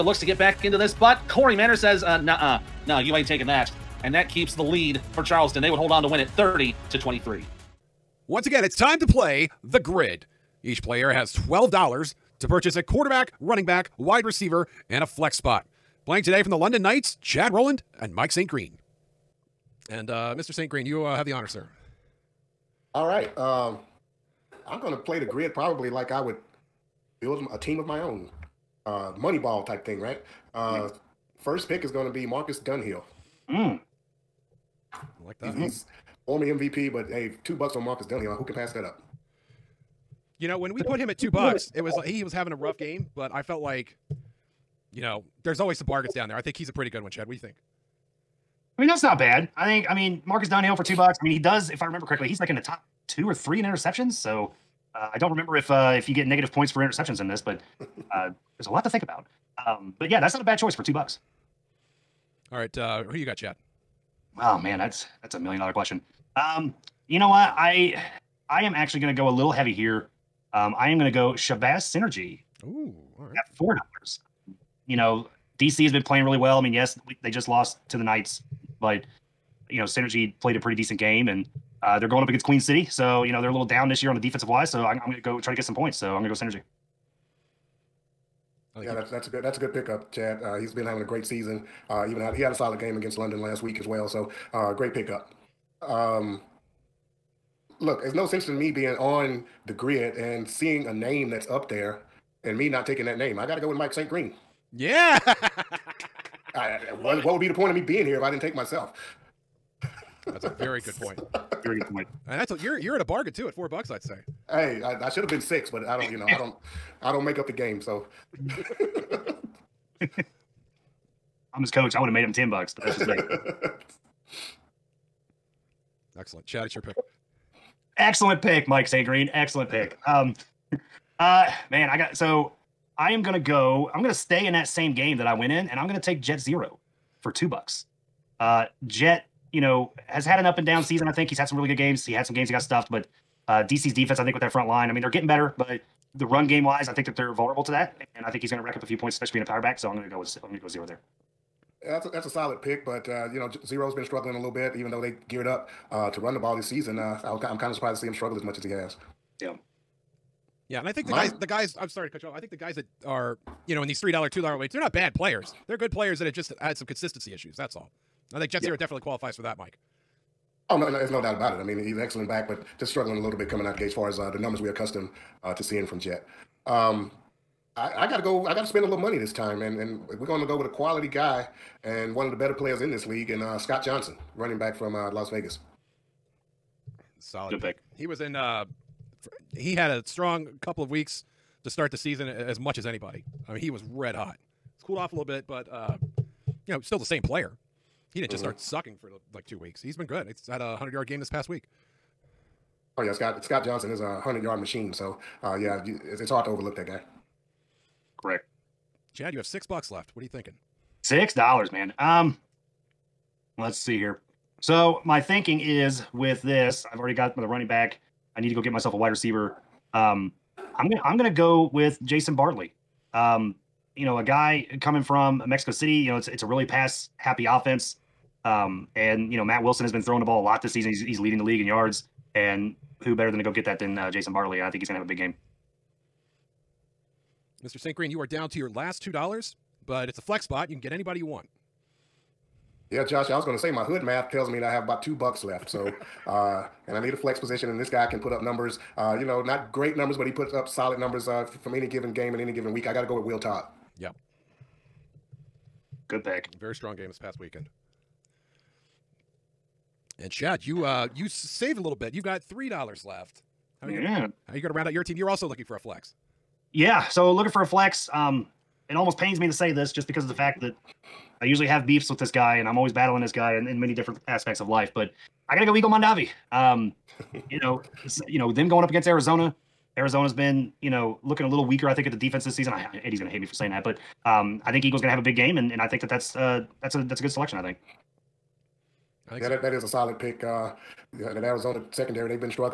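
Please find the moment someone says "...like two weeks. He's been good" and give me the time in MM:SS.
03:19.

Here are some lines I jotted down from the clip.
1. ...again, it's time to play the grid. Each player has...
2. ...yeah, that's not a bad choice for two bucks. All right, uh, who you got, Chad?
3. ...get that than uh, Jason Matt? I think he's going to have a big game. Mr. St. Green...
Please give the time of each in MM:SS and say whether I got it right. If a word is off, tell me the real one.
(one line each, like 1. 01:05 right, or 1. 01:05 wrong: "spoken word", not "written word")
1. 00:08 right
2. 01:00 right
3. 03:53 wrong: "Bartley", not "Matt".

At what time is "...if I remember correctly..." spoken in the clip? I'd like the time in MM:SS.
00:51.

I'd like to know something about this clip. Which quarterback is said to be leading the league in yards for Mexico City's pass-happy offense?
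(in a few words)
Matt Wilson.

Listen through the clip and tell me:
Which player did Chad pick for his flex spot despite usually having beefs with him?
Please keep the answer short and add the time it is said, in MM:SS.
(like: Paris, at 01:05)
Eagle Mondavi, at 04:35.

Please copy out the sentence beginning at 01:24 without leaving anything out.
So I'm, I'm going to go try to get some points.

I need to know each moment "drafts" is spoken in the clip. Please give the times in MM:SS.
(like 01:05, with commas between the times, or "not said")
not said.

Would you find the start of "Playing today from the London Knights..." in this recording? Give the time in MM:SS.
00:16.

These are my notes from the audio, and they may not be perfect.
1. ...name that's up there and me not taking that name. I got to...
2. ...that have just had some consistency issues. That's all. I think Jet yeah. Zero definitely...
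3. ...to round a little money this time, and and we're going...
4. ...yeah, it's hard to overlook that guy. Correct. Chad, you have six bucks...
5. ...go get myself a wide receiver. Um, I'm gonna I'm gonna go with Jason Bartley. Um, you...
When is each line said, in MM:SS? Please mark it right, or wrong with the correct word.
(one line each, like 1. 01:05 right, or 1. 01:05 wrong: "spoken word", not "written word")
1. 01:40 right
2. 02:46 right
3. 02:58 wrong: "spend", not "round"
4. 03:25 right
5. 03:38 right.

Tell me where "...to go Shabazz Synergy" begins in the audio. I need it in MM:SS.
01:11.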